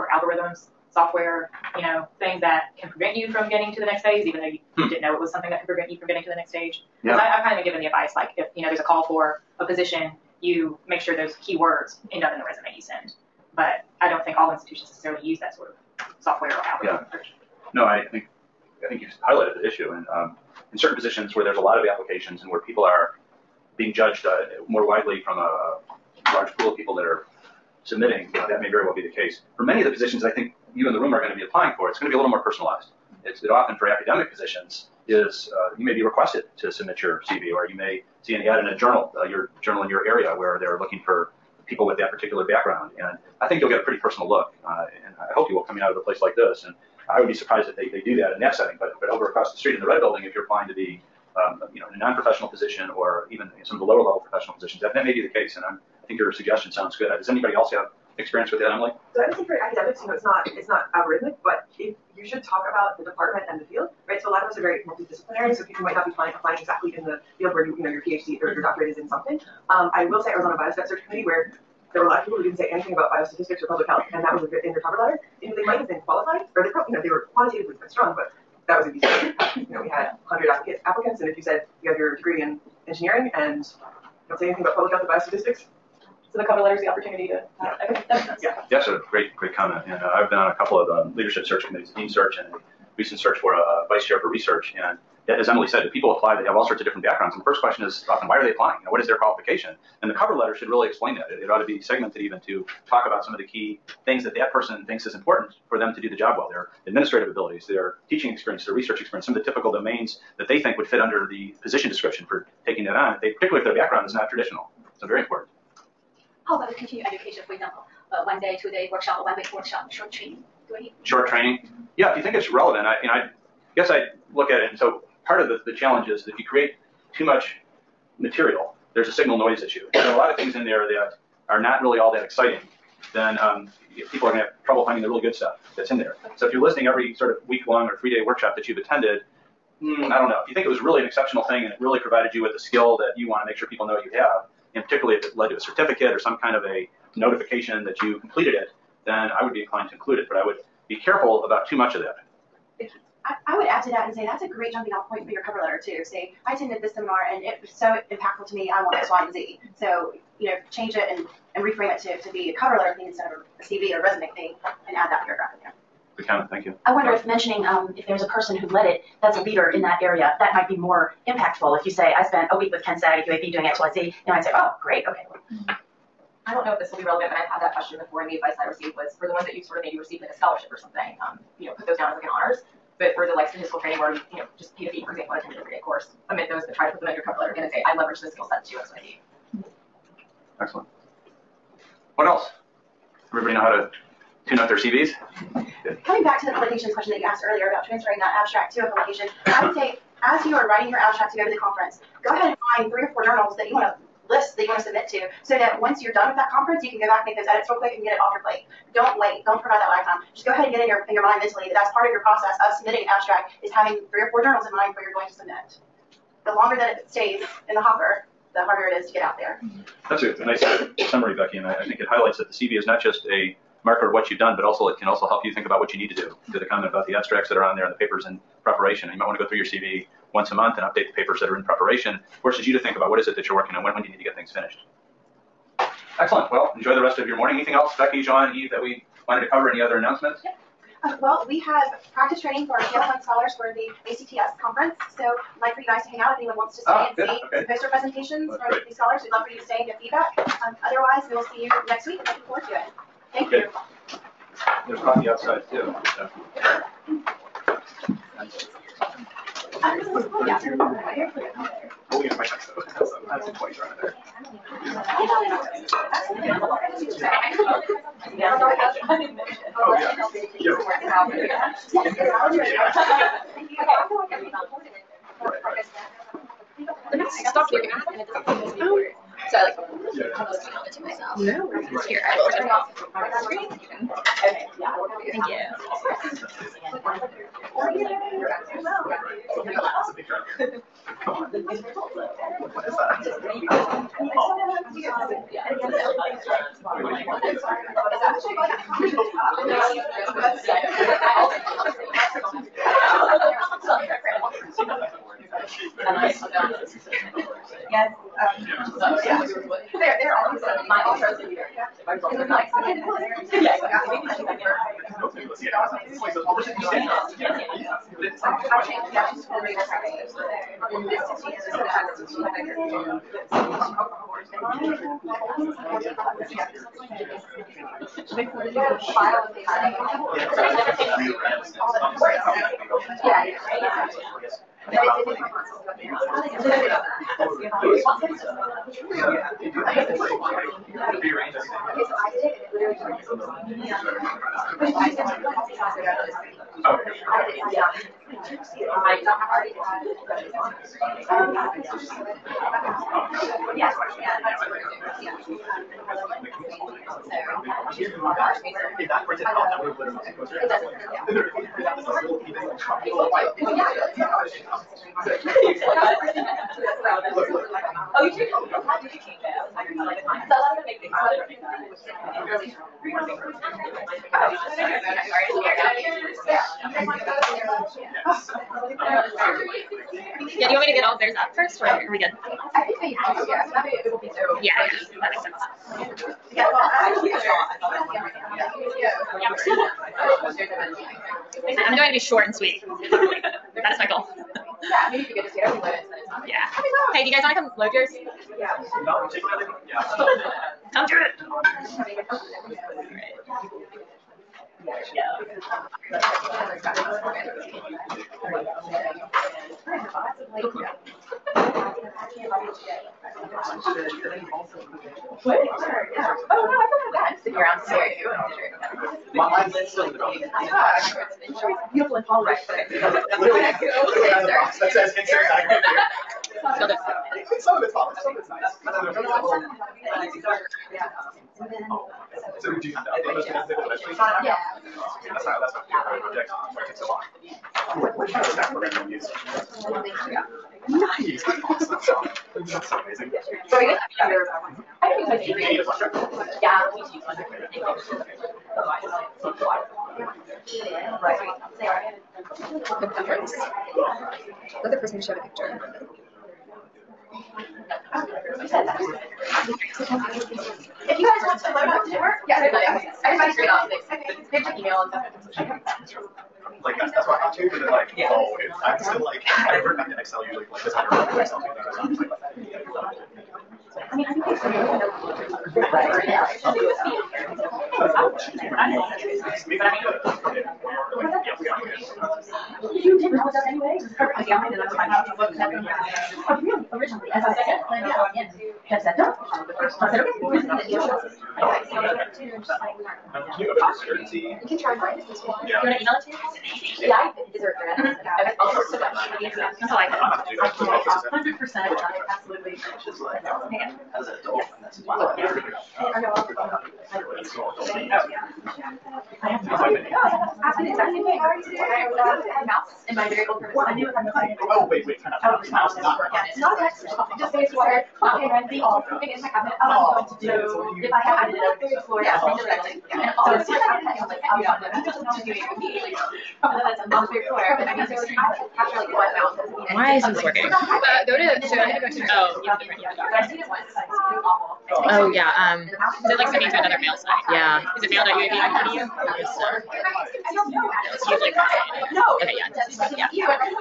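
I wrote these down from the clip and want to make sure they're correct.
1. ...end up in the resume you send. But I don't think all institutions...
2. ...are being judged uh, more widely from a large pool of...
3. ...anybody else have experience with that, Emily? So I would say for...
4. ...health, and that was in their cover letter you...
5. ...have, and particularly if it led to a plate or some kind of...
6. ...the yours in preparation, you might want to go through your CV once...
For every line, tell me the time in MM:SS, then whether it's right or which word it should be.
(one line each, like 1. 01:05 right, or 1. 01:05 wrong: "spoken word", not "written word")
1. 00:12 right
2. 00:22 right
3. 00:57 right
4. 01:13 right
5. 02:24 wrong: "certificate", not "plate"
6. 03:47 wrong: "papers", not "yours".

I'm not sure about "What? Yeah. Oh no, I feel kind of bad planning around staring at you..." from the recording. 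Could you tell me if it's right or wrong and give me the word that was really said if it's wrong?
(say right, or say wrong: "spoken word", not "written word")
wrong: "sitting", not "planning".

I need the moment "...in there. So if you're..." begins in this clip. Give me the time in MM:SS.
02:15.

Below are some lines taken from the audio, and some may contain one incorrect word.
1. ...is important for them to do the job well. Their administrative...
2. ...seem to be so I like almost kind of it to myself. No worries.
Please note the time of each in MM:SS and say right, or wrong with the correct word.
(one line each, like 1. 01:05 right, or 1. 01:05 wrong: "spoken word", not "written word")
1. 01:45 right
2. 04:38 right.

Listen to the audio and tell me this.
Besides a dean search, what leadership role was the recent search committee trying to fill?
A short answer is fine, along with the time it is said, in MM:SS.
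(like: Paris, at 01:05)
Vice chair for research, at 01:33.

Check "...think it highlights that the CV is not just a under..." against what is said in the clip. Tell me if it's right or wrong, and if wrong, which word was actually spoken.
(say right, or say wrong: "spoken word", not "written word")
wrong: "marker", not "under".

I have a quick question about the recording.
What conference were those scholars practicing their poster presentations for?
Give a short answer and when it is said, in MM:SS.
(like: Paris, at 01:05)
ACTS, at 04:04.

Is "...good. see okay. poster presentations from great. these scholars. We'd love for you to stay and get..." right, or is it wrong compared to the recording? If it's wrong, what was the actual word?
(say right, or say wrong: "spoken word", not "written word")
right.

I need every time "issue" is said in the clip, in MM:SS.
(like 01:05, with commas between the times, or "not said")
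00:19, 02:09.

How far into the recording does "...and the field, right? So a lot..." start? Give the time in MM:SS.
01:03.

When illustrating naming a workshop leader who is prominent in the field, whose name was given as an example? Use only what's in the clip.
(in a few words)
Ken Saag.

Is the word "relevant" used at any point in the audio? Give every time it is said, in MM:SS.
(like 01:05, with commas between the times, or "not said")
02:02, 02:57.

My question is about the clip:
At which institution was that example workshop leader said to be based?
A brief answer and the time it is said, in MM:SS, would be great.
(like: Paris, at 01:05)
UAB, at 02:53.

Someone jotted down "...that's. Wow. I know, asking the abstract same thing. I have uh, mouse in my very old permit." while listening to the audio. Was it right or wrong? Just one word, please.
wrong.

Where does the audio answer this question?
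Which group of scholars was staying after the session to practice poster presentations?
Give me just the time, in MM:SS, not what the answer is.
04:02.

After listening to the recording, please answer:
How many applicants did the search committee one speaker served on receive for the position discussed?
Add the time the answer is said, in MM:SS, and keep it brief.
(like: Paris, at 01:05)
100, at 01:20.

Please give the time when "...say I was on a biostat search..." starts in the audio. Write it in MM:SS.
01:10.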